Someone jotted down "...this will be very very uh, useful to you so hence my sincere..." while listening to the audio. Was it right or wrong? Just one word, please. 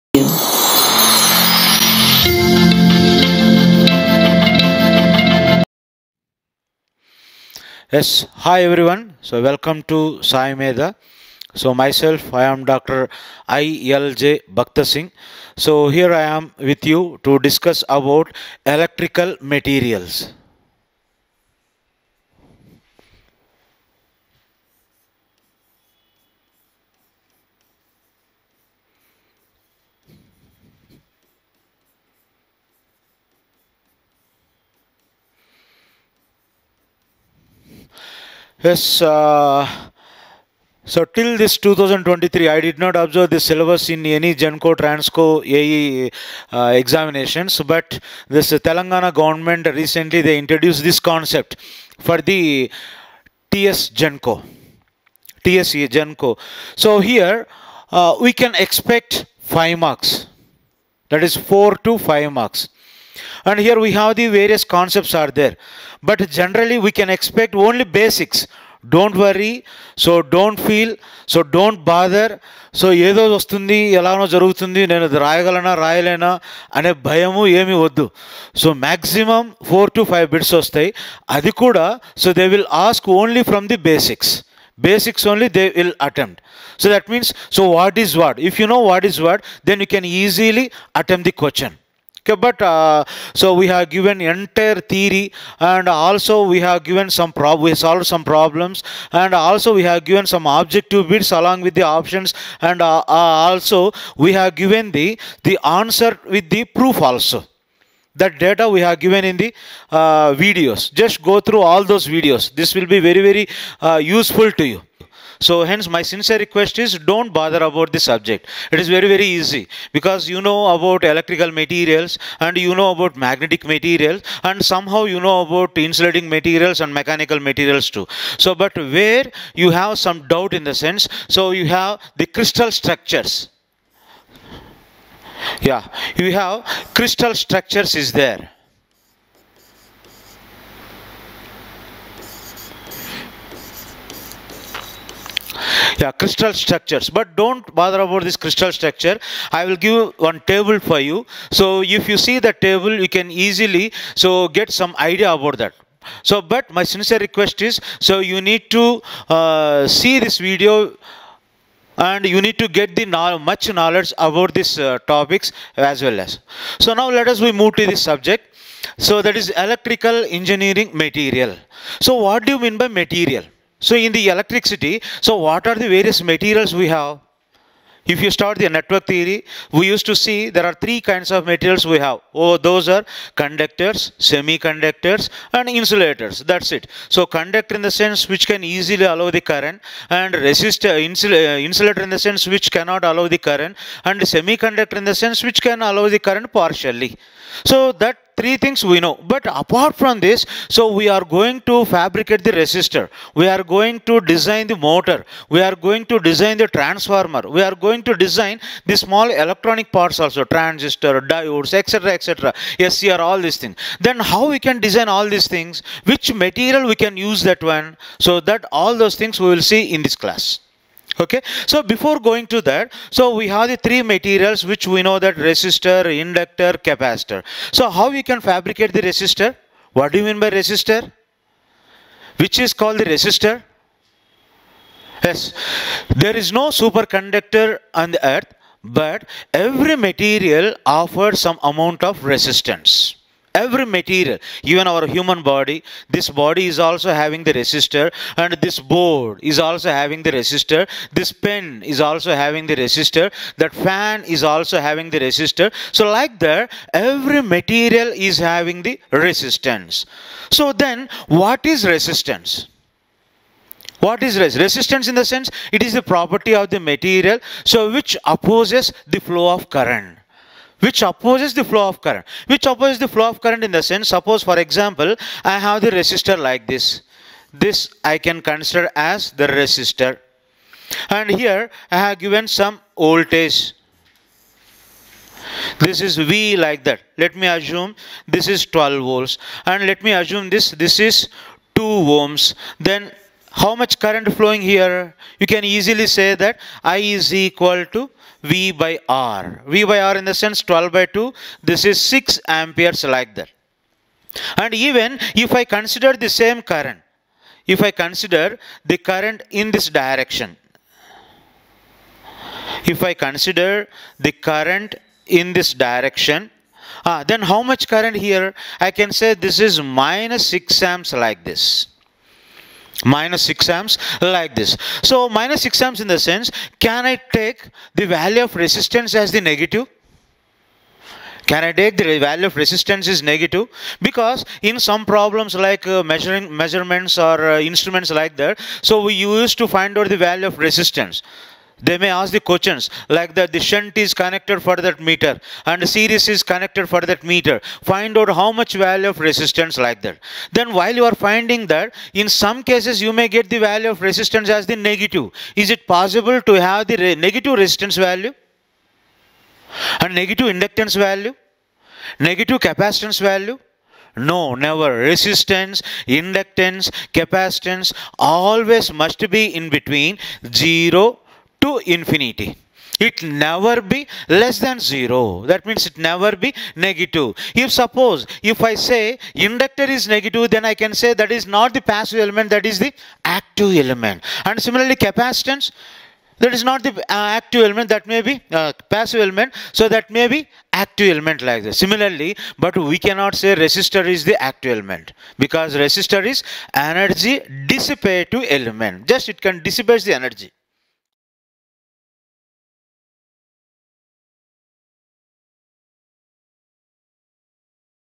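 right.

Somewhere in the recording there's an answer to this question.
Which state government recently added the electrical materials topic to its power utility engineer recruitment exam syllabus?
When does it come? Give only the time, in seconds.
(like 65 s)
48 s.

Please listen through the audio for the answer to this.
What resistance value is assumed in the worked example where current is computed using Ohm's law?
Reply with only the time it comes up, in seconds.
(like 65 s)
291 s.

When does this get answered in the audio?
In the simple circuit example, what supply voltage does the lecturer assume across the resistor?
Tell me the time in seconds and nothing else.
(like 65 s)
288 s.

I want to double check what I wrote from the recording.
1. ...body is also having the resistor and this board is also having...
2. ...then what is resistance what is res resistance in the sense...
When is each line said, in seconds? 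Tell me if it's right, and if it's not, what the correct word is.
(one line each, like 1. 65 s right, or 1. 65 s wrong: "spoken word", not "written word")
1. 246 s right
2. 260 s right.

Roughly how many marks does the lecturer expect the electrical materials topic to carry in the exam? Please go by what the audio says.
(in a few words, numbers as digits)
4 to 5.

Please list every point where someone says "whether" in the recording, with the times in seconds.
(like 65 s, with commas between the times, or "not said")
not said.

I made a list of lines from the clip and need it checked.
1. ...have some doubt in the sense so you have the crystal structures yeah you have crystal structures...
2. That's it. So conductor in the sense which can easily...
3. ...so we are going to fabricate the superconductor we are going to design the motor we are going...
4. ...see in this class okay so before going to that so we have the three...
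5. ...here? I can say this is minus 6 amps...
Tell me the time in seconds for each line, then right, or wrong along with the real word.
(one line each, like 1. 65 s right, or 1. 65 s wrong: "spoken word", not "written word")
1. 129 s right
2. 186 s right
3. 200 s wrong: "resistor", not "superconductor"
4. 219 s right
5. 318 s right.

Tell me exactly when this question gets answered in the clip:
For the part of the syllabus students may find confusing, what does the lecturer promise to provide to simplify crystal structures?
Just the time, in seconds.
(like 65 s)
150 s.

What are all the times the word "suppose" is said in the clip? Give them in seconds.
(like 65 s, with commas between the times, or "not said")
274 s, 377 s.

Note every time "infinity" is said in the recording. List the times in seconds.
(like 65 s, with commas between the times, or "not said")
371 s.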